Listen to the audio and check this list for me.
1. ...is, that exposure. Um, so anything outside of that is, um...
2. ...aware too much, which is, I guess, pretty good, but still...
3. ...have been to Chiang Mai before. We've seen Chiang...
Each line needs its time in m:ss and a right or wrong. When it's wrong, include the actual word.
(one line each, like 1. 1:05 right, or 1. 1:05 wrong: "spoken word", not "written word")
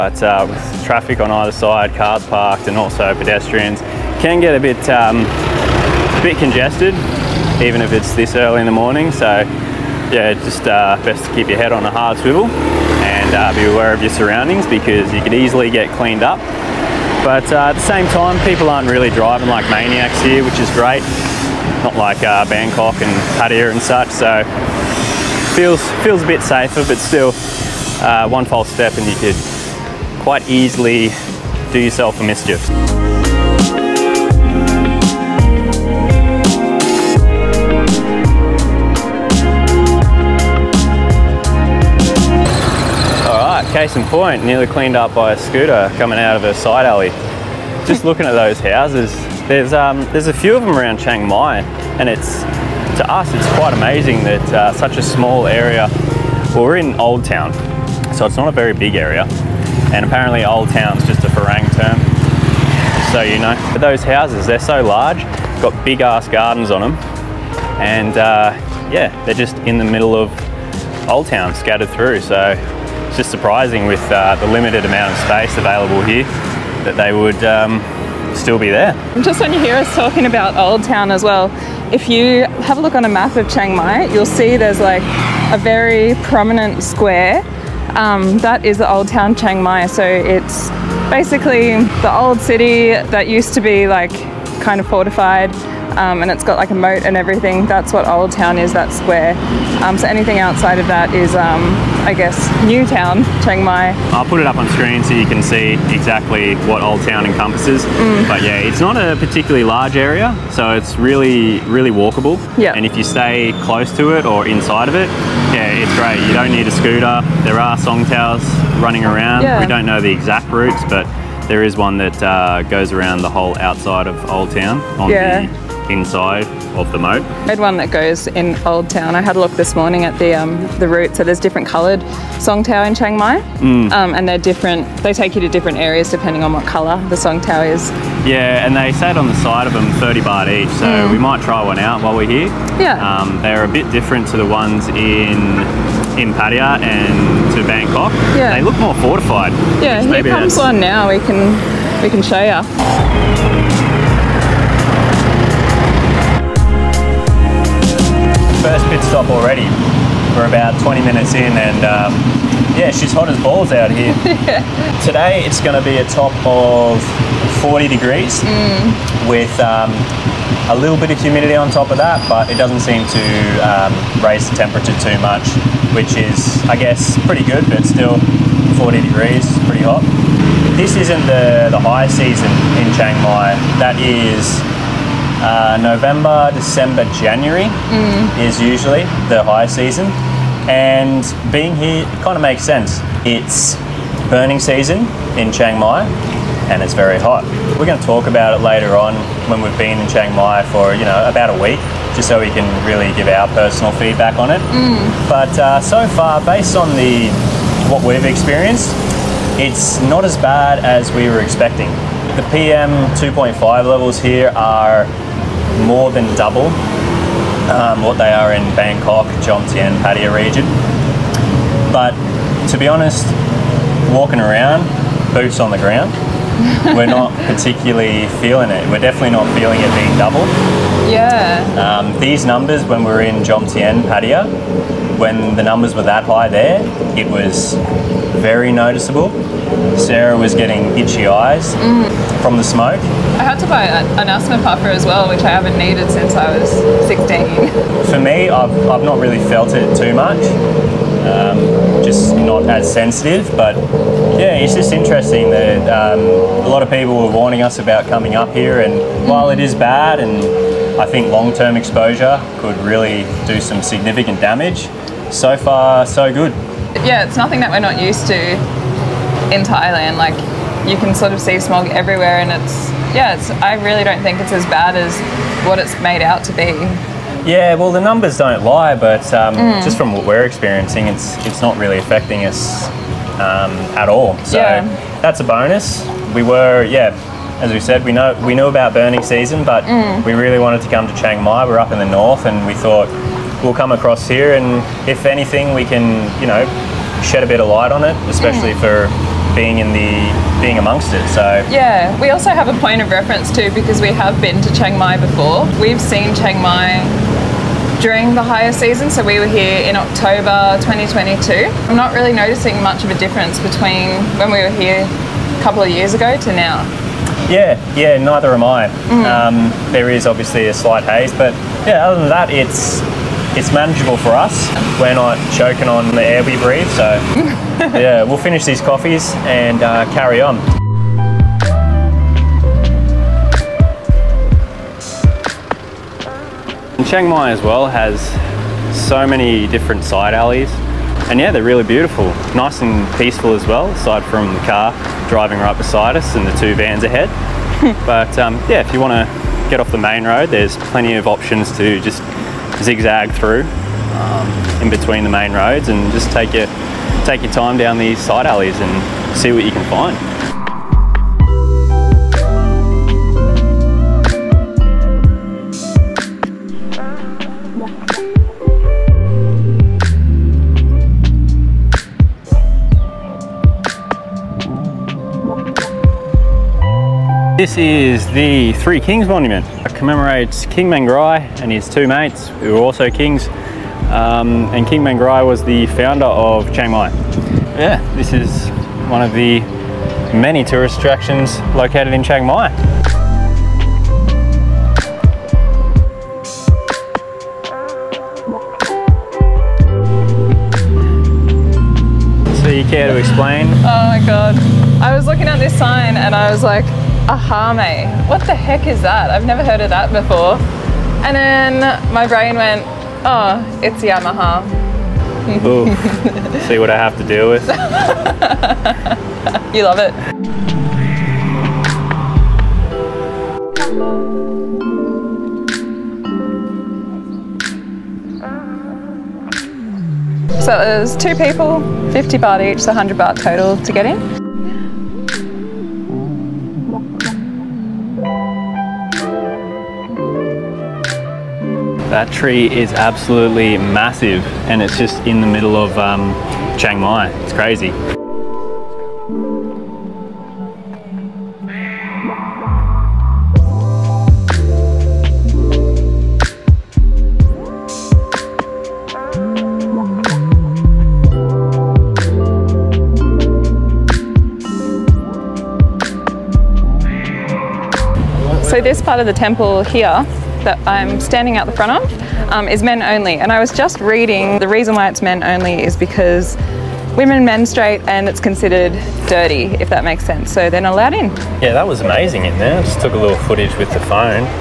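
1. 1:38 wrong: "square", not "exposure"
2. 2:54 wrong: "temperature", not "aware"
3. 5:04 right.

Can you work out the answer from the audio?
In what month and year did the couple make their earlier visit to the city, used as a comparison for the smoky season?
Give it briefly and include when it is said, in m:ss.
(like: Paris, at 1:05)
October 2022, at 5:09.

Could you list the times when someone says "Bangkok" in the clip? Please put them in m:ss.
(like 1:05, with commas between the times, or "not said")
0:22, 2:27, 3:38.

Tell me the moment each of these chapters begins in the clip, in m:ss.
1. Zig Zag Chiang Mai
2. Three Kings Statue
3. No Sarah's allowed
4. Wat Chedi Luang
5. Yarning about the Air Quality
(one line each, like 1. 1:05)
1. 5:36
2. 6:12
3. 7:33
4. 7:00
5. 2:36.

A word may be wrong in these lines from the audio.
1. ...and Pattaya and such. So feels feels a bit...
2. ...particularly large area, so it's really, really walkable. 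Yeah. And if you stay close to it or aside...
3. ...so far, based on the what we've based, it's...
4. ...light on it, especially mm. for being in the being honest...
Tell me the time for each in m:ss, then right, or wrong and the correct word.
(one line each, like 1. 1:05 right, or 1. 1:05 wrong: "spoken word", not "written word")
1. 0:22 right
2. 1:49 wrong: "inside", not "aside"
3. 3:25 wrong: "experienced", not "based"
4. 4:57 wrong: "amongst", not "honest".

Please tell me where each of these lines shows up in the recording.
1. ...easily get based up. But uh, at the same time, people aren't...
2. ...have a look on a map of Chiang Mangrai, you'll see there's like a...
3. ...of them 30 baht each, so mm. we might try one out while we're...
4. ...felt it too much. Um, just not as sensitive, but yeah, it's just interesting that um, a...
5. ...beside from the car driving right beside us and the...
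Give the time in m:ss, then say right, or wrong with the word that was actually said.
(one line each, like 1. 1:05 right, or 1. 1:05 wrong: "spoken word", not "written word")
1. 0:15 wrong: "cleaned", not "based"
2. 1:22 wrong: "Mai", not "Mangrai"
3. 2:19 right
4. 4:09 right
5. 5:43 wrong: "aside", not "beside".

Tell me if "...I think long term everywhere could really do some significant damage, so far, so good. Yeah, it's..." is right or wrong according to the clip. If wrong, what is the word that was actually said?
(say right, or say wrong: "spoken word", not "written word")
wrong: "exposure", not "everywhere".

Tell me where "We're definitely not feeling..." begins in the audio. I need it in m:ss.
3:48.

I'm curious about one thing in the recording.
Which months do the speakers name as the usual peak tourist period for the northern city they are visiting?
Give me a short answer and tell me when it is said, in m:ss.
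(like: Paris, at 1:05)
November, December, January, at 3:05.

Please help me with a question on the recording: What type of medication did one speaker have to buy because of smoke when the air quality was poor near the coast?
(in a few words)
Asthma puffer.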